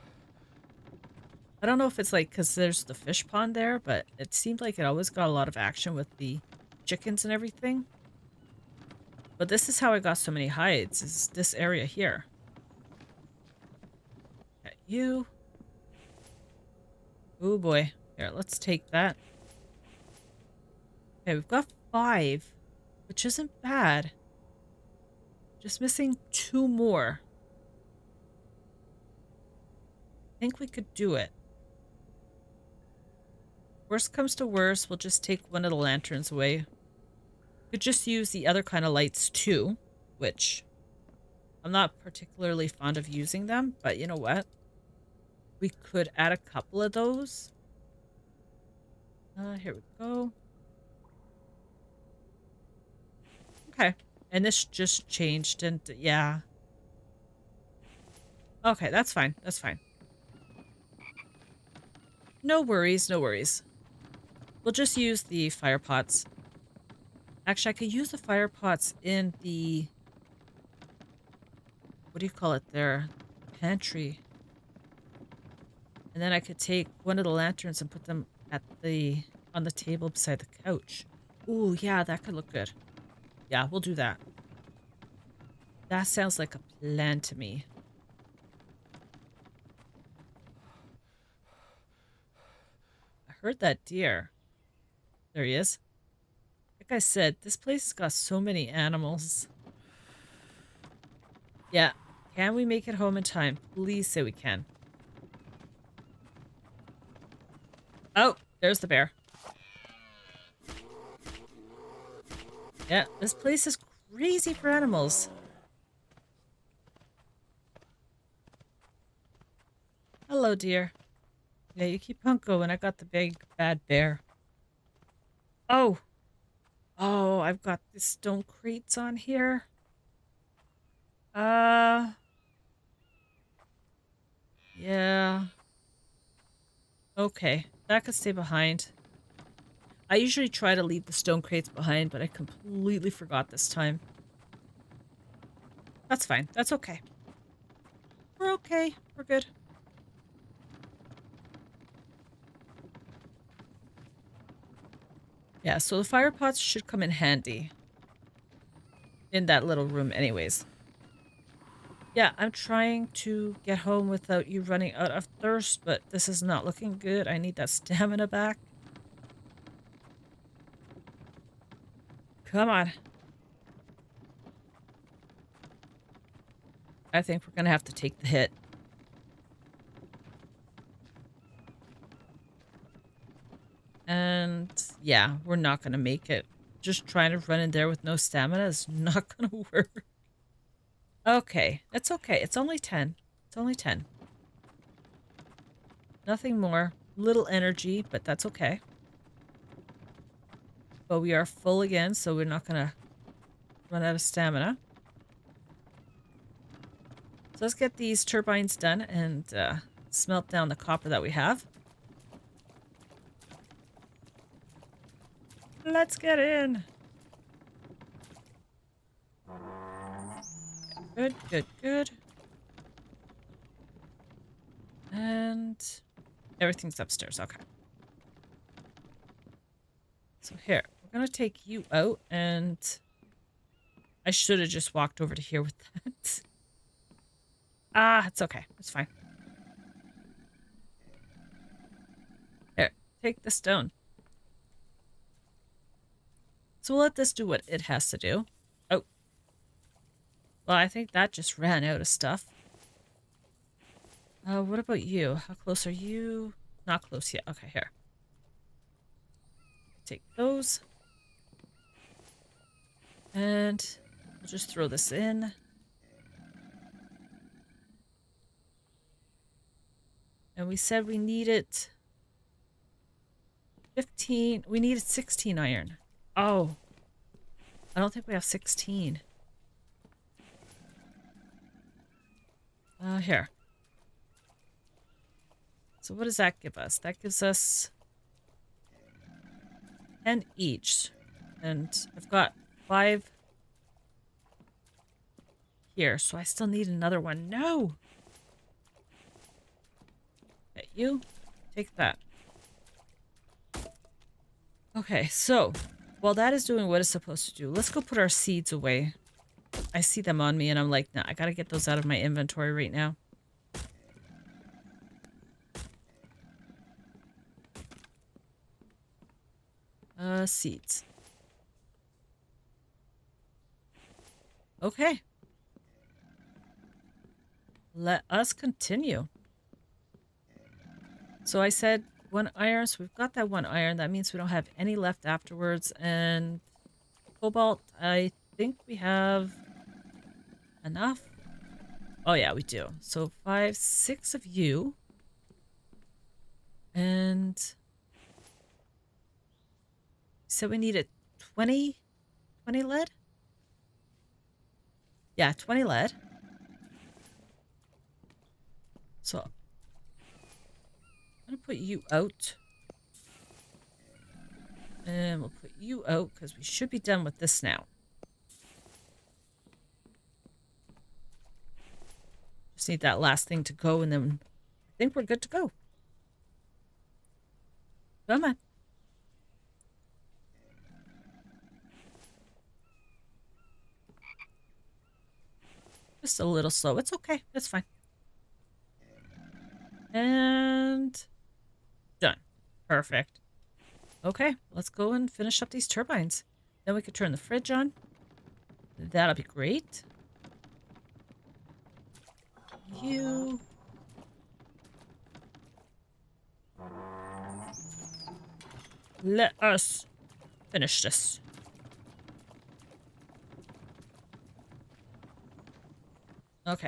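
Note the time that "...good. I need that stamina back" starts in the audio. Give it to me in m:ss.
2:46.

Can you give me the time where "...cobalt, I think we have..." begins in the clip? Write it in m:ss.
5:37.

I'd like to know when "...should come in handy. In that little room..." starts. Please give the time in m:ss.
2:36.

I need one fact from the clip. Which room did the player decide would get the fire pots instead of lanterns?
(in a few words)
Pantry.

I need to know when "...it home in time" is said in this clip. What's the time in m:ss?
1:42.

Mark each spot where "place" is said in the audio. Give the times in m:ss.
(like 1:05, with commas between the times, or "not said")
1:37, 1:53.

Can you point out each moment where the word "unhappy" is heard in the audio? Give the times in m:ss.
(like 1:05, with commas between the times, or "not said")
not said.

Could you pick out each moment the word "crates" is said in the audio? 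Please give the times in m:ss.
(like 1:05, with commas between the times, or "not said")
2:08, 2:21.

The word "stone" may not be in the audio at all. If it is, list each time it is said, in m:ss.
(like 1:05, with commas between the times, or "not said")
2:07, 2:21, 4:03.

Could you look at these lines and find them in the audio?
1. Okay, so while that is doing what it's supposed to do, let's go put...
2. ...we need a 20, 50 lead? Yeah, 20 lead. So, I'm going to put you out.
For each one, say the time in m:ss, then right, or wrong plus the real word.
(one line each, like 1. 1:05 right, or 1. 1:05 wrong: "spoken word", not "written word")
1. 5:04 right
2. 5:50 wrong: "20", not "50".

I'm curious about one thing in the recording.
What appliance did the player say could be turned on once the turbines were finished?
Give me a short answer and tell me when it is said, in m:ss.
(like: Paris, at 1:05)
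Fridge, at 6:37.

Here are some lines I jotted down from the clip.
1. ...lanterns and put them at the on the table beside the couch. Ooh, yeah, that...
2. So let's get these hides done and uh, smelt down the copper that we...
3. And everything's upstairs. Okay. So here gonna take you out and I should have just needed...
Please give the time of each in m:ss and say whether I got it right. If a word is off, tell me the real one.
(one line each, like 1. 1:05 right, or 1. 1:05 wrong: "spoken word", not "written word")
1. 1:17 right
2. 3:27 wrong: "turbines", not "hides"
3. 3:45 wrong: "walked", not "needed".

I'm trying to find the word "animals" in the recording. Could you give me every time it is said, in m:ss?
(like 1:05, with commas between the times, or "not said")
1:38, 1:54.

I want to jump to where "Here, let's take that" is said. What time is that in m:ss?
0:18.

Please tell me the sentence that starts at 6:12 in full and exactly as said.
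Just need that last thing to go and then I think we're good to go.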